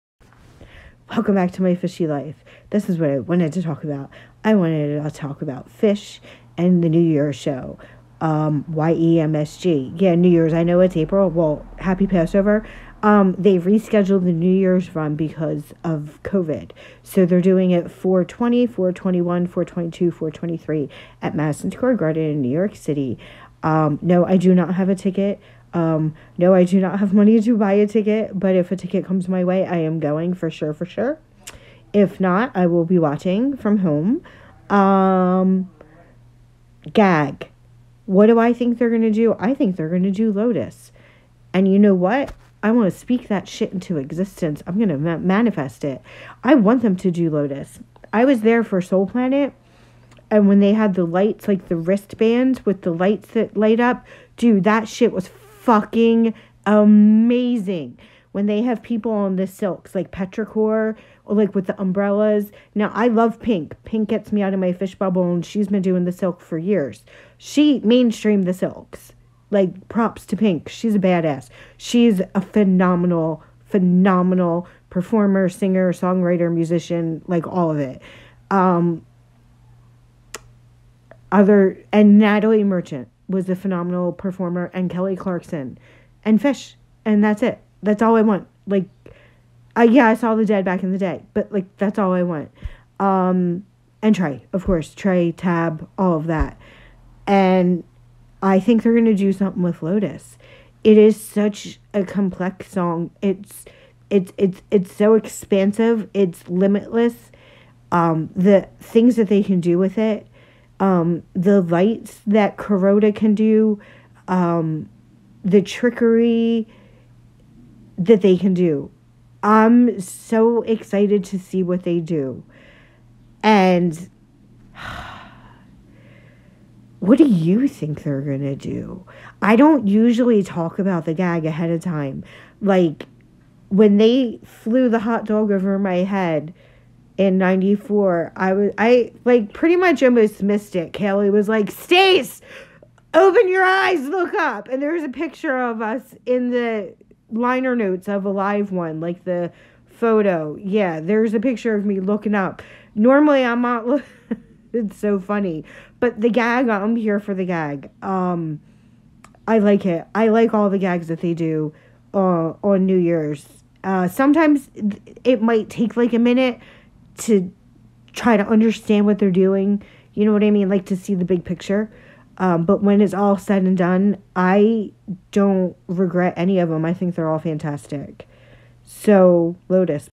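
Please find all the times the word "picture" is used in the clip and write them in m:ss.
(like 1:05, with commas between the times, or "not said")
2:25, 2:31, 2:51.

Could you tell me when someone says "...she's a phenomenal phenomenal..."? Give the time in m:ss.
1:11.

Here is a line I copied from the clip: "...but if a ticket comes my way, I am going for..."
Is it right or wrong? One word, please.
right.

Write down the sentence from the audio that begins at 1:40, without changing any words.
It is such a complex song.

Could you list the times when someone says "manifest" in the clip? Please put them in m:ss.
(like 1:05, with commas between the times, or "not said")
0:45.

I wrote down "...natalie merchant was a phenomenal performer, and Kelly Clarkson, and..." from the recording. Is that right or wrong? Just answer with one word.
right.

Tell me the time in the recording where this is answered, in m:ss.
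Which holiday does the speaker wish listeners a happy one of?
0:12.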